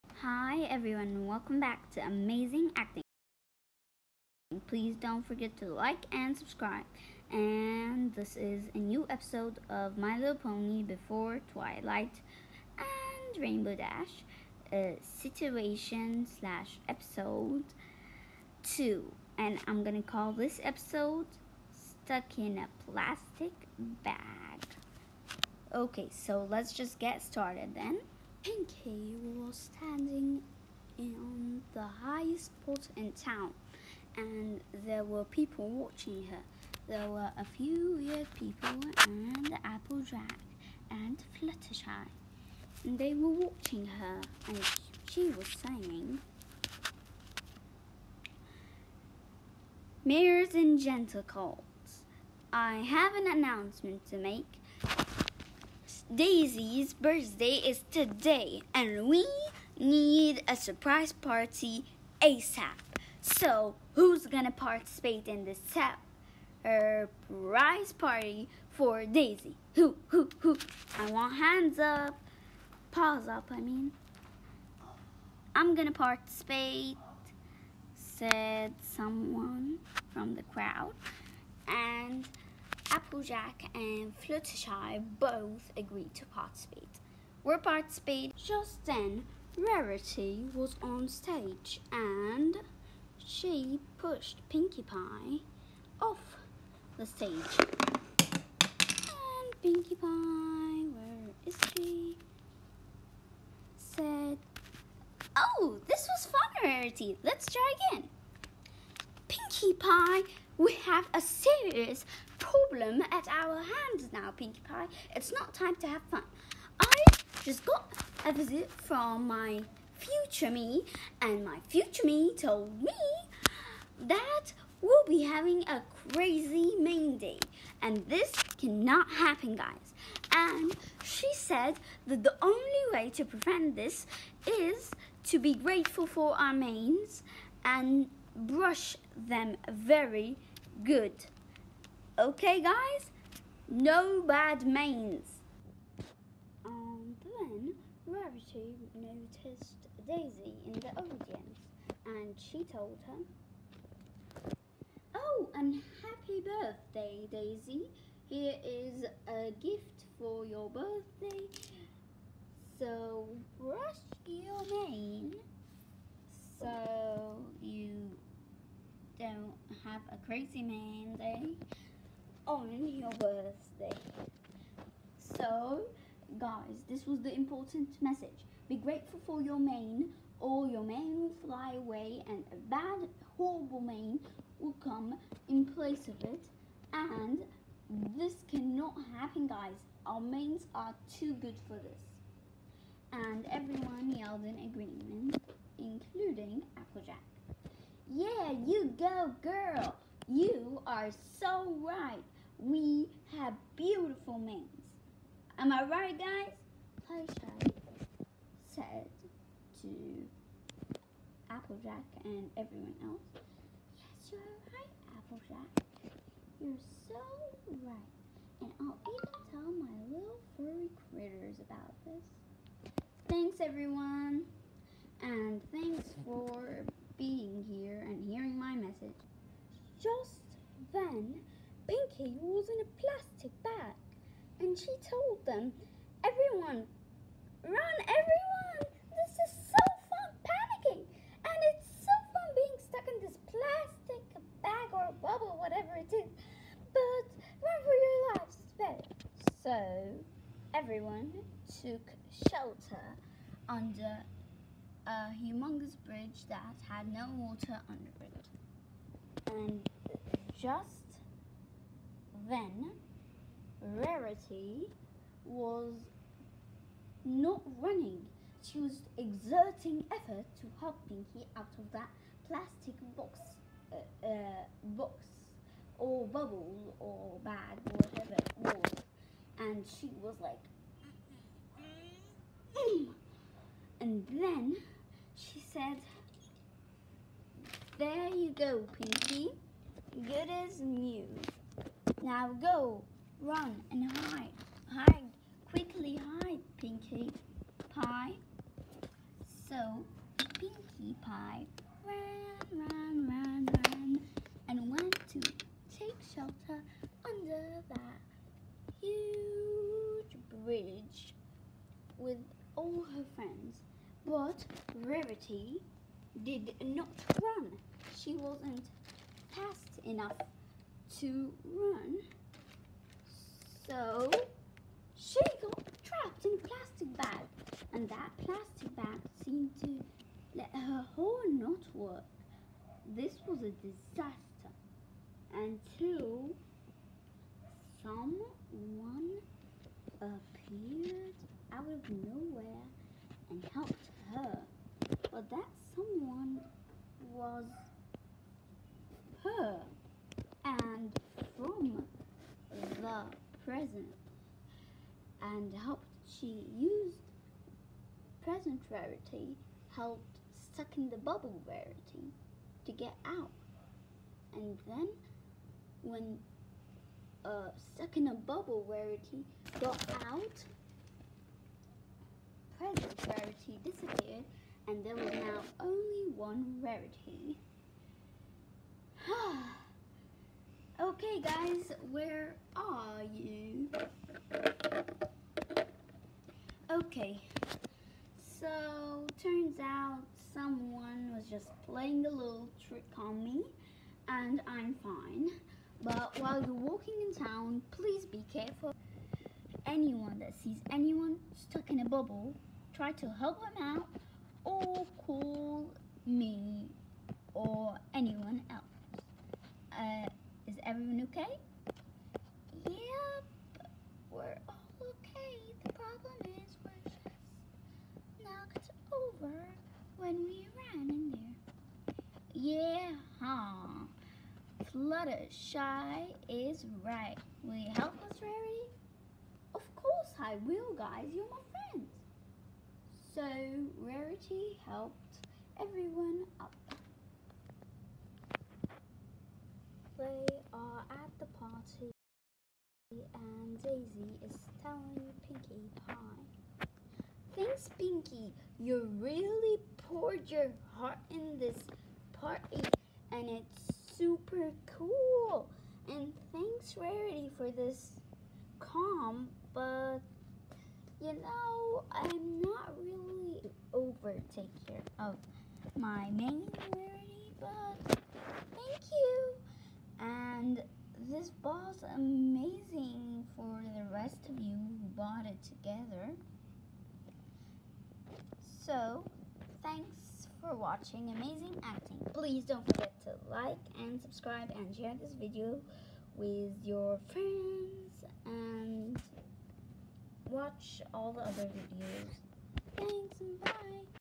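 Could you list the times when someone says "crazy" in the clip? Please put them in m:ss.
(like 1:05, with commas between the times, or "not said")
2:06, 2:50.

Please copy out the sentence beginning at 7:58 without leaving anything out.
So, thanks for watching Amazing Acting.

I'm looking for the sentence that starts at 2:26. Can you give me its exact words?
And then Rarity noticed Daisy in the audience and she told her, Oh, and happy birthday, Daisy.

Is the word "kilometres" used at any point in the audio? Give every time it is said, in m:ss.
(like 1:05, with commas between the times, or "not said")
not said.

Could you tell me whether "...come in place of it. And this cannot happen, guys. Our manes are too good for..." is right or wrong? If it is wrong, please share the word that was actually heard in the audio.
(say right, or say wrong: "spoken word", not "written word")
right.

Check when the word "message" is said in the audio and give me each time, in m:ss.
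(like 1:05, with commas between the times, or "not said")
2:58, 3:48.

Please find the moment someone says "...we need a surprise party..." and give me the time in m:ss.
0:59.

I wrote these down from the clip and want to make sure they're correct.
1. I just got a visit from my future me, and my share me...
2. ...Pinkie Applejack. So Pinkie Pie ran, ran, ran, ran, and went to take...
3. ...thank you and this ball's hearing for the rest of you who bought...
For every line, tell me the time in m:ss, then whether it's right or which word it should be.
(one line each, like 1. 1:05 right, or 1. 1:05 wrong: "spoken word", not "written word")
1. 1:56 wrong: "future", not "share"
2. 4:56 wrong: "Pie", not "Applejack"
3. 7:48 wrong: "amazing", not "hearing".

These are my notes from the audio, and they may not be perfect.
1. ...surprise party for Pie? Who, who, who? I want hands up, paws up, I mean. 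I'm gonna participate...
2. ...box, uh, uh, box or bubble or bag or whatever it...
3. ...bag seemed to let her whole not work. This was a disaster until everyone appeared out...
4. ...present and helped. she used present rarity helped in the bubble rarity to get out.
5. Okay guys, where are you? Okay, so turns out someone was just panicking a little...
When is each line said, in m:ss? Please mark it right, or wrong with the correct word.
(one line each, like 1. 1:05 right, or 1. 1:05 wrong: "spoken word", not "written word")
1. 1:06 wrong: "Daisy", not "Pie"
2. 4:33 right
3. 5:28 wrong: "someone", not "everyone"
4. 5:53 right
5. 6:21 wrong: "playing", not "panicking".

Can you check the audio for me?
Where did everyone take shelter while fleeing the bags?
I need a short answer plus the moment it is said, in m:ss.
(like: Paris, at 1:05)
under a humongous bridge, at 4:13.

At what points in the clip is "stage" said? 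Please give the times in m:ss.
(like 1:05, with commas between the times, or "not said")
1:31, 1:37.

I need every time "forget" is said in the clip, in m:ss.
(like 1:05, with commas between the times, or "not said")
0:05, 8:02.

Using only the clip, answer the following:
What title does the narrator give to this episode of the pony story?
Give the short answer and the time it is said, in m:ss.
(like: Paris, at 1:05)
Stuck in a Plastic Bag, at 0:21.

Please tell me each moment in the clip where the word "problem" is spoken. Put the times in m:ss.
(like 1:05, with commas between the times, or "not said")
1:52, 6:55.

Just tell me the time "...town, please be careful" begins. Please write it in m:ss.
6:37.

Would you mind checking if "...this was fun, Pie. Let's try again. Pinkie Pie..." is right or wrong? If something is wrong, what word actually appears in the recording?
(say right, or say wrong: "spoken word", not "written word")
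wrong: "Rarity", not "Pie".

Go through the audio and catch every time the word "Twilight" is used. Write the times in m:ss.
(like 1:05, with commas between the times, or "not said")
0:11.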